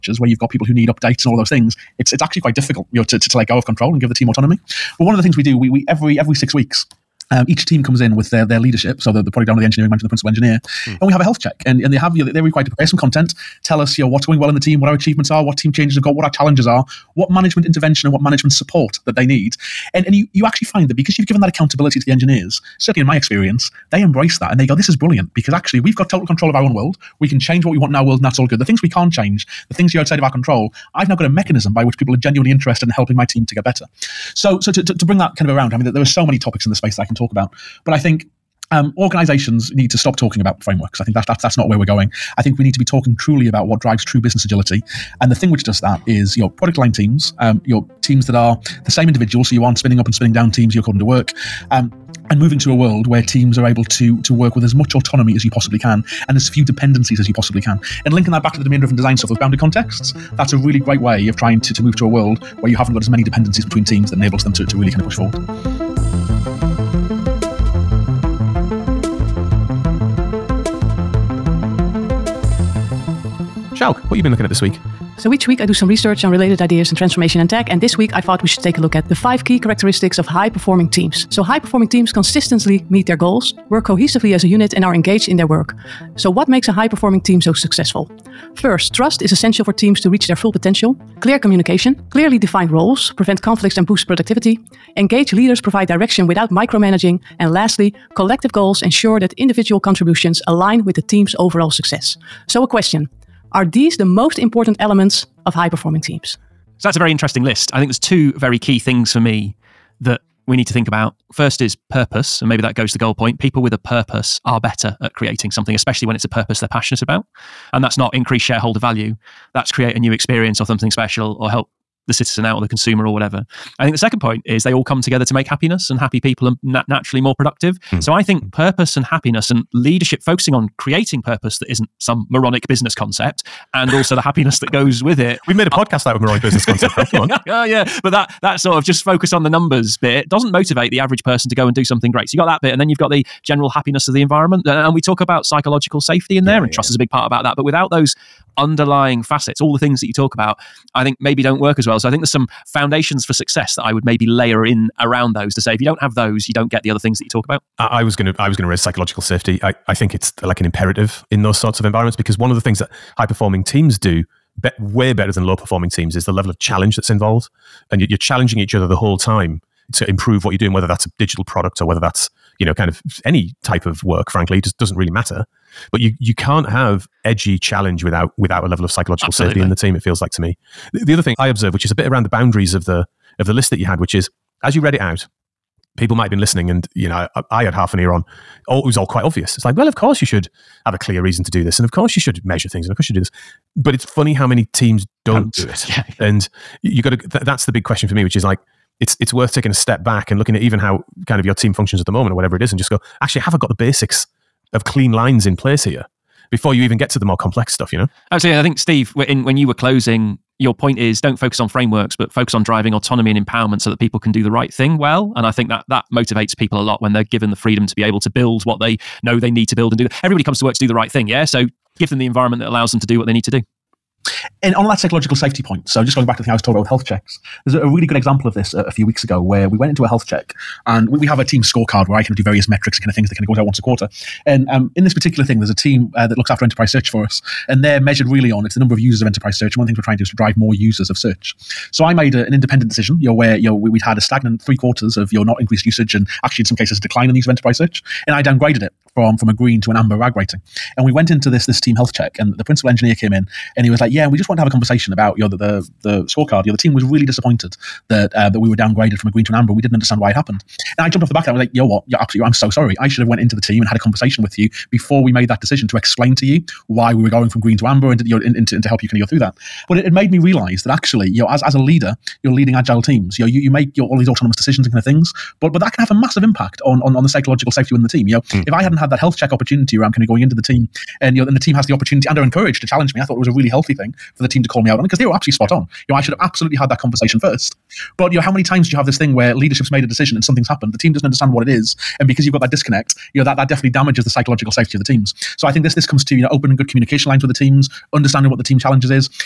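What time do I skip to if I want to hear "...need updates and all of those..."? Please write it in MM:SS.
00:00.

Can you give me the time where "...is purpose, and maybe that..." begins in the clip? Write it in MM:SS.
01:51.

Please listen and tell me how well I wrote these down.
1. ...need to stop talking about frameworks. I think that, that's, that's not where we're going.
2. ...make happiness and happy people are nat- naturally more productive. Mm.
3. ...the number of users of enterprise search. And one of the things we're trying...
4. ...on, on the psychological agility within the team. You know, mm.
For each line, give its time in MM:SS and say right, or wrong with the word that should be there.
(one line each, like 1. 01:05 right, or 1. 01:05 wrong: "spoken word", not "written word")
1. 00:39 right
2. 02:05 right
3. 03:58 right
4. 04:37 wrong: "safety", not "agility".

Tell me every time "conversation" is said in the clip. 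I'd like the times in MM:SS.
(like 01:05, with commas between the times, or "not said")
04:14, 04:23, 04:46.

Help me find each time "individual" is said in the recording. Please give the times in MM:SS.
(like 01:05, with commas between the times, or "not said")
00:49, 01:39.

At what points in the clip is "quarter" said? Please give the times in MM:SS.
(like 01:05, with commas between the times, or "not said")
03:53, 04:04.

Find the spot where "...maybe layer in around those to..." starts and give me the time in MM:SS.
02:34.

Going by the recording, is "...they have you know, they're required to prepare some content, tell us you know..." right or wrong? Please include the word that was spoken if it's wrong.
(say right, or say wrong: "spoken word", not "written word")
right.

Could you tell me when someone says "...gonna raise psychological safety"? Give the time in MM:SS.
02:38.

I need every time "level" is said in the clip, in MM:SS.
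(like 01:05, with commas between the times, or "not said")
02:46, 02:58.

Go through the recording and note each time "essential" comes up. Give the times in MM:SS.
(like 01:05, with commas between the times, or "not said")
01:29.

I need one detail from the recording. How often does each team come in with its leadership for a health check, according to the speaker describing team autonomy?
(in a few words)
Every 6 weeks.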